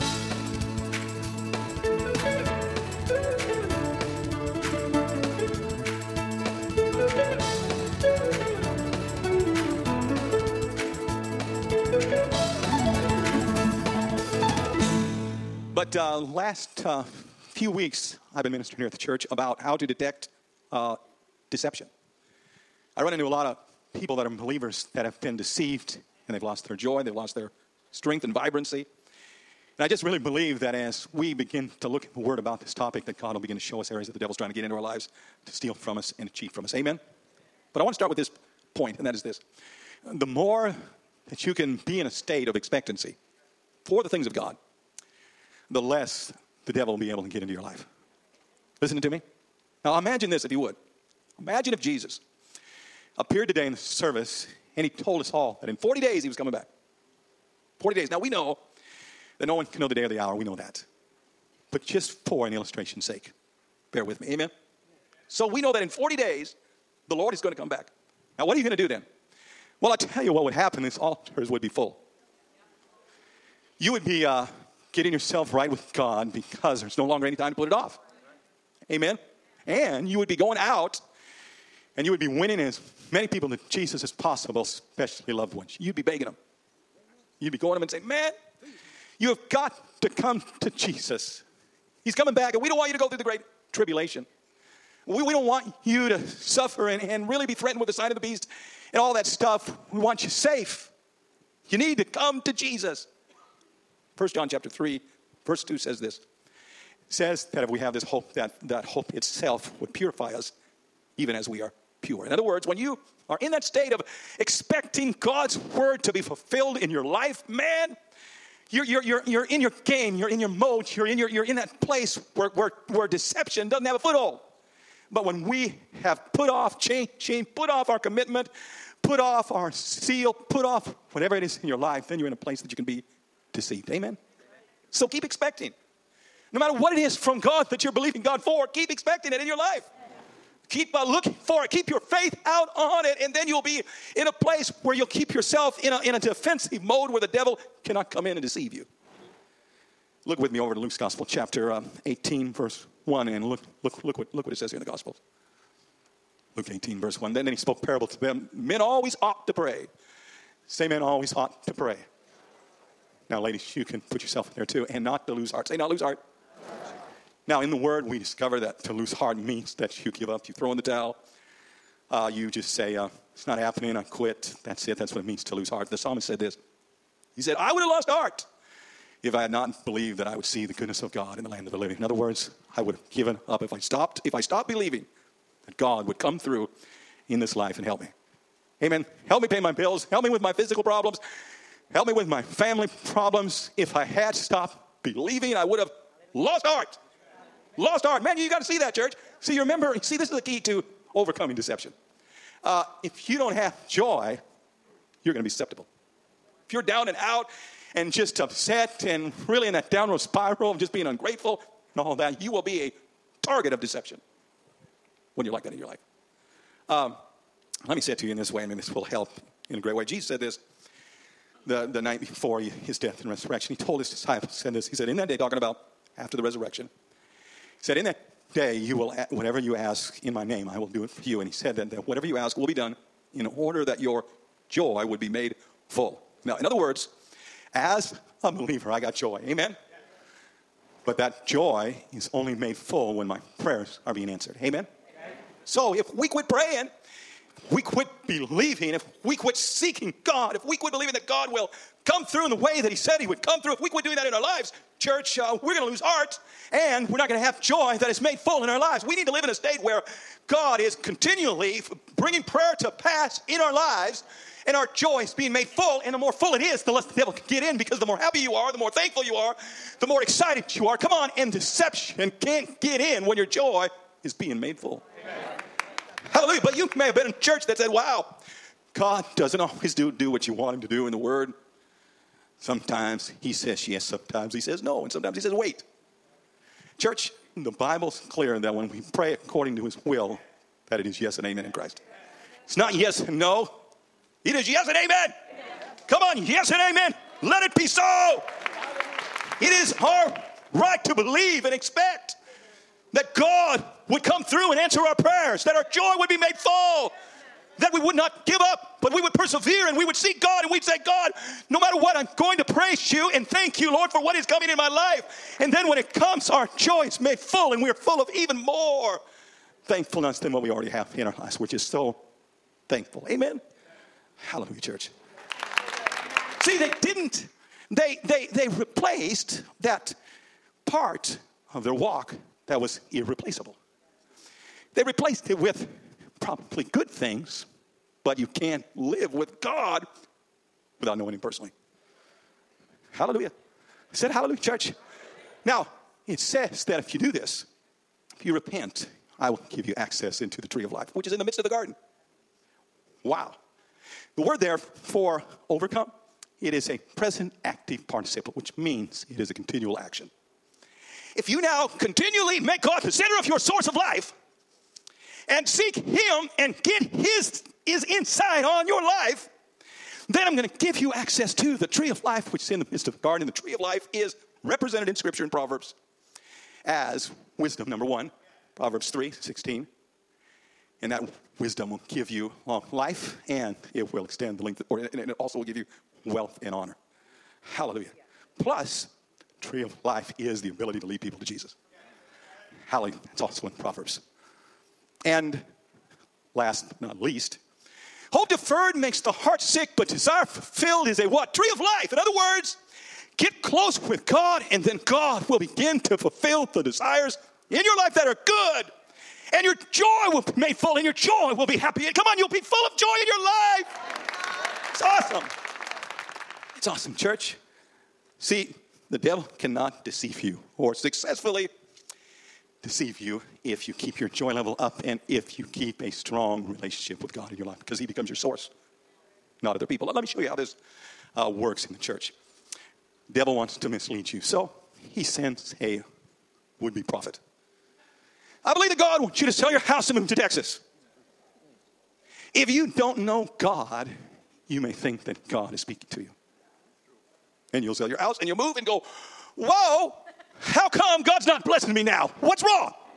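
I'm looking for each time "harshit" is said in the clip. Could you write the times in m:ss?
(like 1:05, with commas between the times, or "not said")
not said.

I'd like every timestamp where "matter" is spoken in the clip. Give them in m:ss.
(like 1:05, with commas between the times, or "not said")
2:16, 5:11.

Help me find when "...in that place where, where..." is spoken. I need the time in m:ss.
2:01.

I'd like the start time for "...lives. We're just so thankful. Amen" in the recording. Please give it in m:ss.
5:21.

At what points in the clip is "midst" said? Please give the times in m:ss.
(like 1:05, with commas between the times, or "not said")
5:51, 6:12.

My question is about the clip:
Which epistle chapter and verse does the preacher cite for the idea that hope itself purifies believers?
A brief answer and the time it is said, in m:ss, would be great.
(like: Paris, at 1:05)
1 John 3:2, at 1:44.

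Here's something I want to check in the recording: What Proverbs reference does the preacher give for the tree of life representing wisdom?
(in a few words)
Proverbs 3:16.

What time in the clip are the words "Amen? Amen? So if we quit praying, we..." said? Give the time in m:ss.
4:04.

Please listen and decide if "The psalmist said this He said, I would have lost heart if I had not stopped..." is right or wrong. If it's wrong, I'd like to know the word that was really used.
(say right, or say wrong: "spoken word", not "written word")
wrong: "believed", not "stopped".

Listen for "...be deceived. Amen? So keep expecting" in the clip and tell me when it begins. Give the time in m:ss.
2:12.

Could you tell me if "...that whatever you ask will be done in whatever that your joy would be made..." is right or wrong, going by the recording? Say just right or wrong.
wrong.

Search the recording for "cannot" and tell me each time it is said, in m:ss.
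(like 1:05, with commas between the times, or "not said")
2:27, 6:59.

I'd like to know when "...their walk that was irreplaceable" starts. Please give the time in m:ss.
5:31.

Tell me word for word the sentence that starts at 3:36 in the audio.
Um, let me say it to you in this way, and maybe this will help in a great way.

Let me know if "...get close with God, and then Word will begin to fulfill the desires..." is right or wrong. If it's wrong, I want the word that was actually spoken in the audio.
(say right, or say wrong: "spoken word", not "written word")
wrong: "God", not "Word".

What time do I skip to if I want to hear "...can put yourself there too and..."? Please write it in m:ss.
2:43.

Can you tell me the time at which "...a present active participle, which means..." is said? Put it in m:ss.
5:56.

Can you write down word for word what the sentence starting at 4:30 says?
Come on, and deception can't get in when your joy is being made full.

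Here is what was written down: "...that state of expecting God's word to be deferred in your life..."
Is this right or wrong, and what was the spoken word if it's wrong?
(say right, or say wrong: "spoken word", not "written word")
wrong: "fulfilled", not "deferred".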